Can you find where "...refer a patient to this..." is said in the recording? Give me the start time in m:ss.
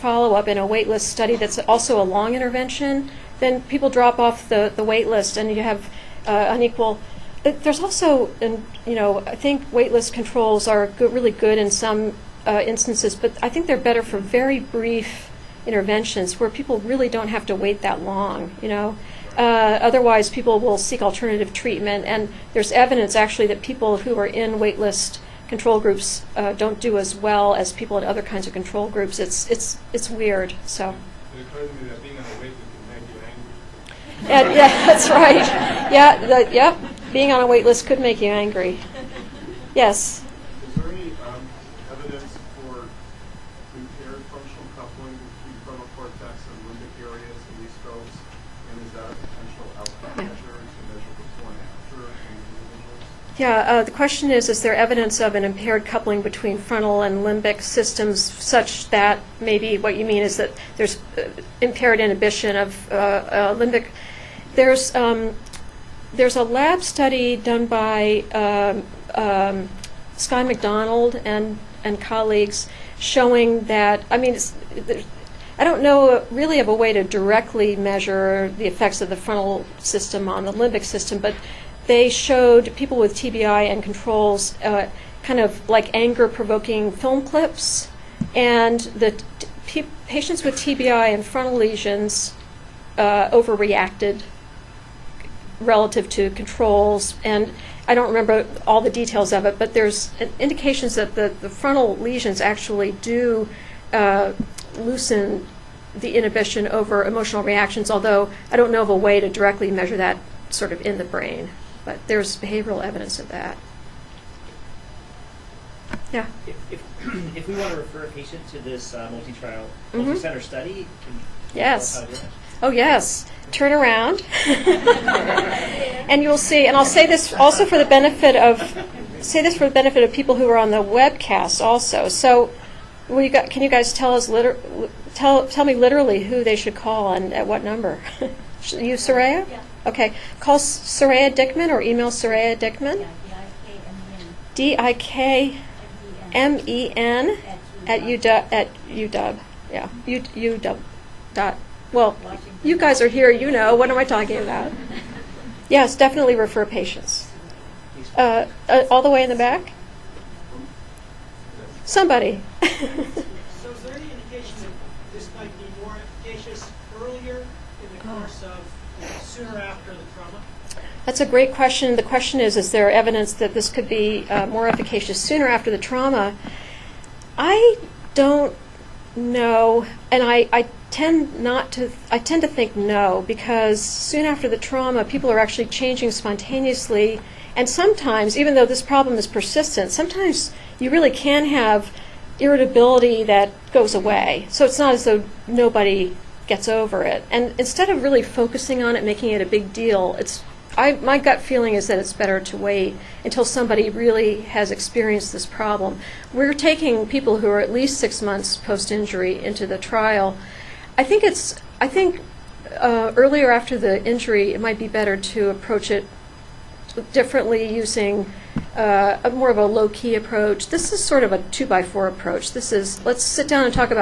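1:57.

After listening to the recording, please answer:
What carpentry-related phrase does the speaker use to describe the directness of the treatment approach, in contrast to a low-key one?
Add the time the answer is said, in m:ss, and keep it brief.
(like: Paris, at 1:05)
two by four approach, at 3:41.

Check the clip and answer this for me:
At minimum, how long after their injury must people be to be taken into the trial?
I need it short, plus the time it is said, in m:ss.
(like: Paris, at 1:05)
6 months, at 3:27.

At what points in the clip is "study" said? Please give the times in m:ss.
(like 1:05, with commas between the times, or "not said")
0:01, 1:06, 2:00.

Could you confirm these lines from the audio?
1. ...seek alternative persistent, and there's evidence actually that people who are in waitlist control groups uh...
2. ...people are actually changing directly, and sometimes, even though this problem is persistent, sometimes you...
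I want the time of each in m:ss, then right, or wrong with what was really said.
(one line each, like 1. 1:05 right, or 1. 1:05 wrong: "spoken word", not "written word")
1. 0:20 wrong: "treatment", not "persistent"
2. 3:05 wrong: "spontaneously", not "directly".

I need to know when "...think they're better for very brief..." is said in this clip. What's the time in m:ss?
0:13.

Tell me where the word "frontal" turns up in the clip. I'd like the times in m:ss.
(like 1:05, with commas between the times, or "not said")
0:56, 1:19, 1:31, 1:41.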